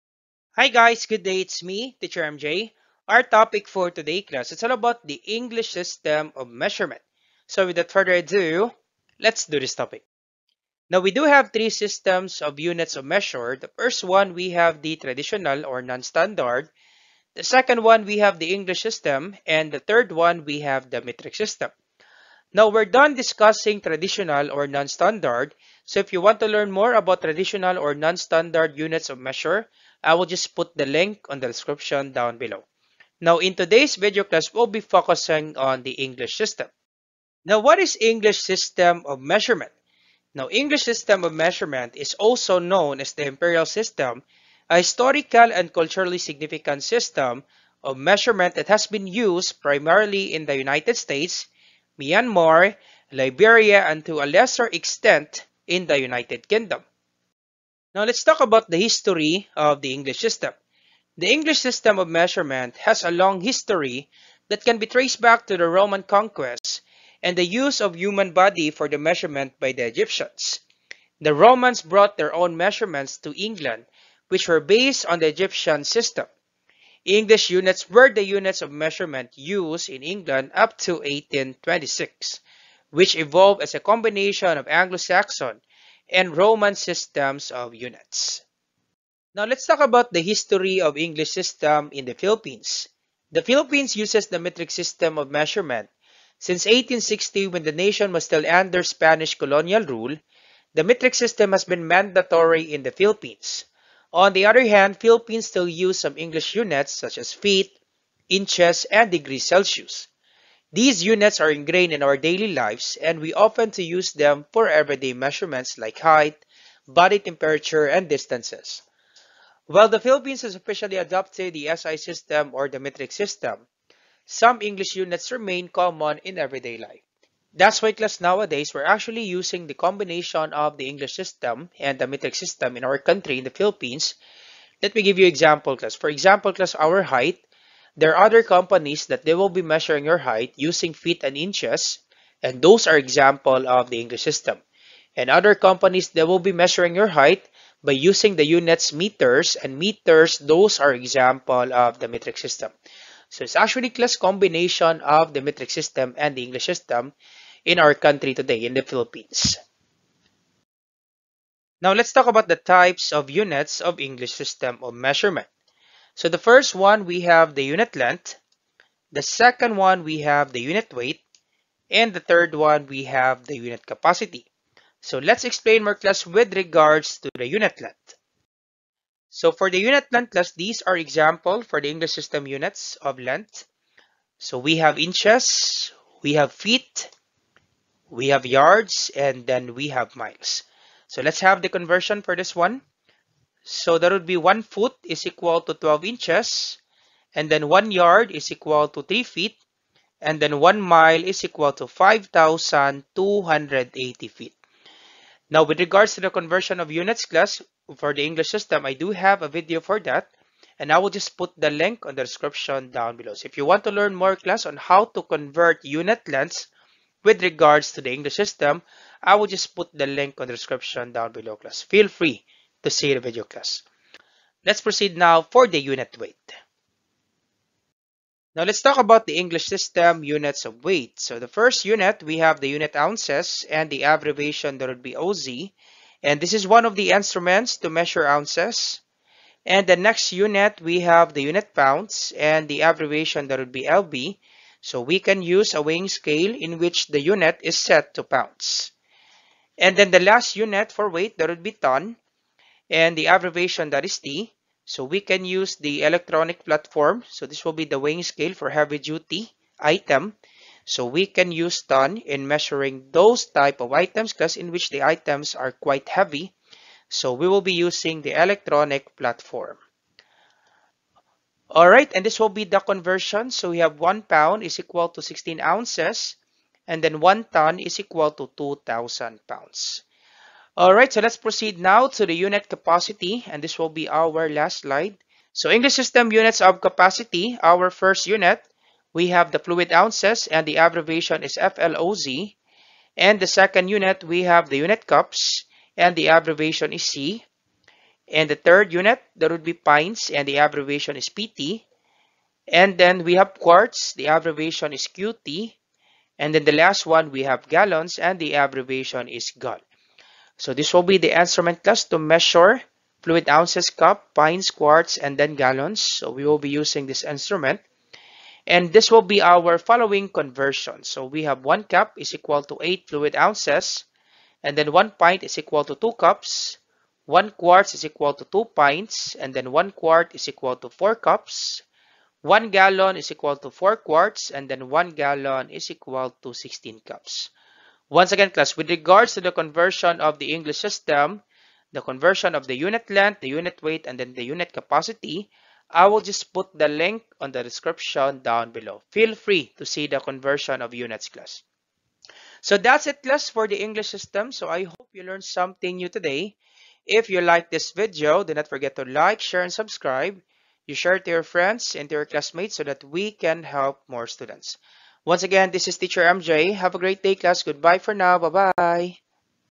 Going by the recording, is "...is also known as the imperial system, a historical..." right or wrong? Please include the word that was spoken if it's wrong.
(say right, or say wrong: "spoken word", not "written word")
right.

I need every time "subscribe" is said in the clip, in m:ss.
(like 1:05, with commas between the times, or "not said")
5:59.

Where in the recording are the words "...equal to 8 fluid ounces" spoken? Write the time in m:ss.
5:22.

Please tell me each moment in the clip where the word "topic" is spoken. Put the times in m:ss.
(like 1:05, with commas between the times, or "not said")
0:03, 0:09.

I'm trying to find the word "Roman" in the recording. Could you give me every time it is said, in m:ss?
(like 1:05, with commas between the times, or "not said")
1:05, 1:11, 1:26.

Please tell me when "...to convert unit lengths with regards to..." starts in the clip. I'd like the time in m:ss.
3:35.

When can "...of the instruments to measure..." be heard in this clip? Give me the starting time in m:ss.
3:56.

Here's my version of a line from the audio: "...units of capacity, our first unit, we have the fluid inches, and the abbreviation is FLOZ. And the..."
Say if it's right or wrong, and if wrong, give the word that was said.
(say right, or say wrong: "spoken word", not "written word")
wrong: "ounces", not "inches".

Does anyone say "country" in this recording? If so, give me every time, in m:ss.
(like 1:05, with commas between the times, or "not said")
2:12, 2:37.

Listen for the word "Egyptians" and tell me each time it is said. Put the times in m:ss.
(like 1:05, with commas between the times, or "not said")
1:09, 1:15.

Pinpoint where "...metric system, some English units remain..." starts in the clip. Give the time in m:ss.
2:02.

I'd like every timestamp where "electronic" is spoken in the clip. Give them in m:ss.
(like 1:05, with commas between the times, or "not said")
4:16, 4:28.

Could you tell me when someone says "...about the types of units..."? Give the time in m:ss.
2:42.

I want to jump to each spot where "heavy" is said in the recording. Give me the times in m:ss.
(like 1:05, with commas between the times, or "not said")
4:18, 4:26.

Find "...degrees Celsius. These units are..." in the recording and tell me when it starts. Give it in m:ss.
1:49.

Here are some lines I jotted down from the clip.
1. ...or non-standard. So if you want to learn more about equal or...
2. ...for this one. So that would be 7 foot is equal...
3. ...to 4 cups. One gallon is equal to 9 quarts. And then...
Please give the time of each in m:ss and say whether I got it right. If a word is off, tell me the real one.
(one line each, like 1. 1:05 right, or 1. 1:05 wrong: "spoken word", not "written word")
1. 0:24 wrong: "traditional", not "equal"
2. 3:12 wrong: "1", not "7"
3. 5:30 wrong: "4", not "9".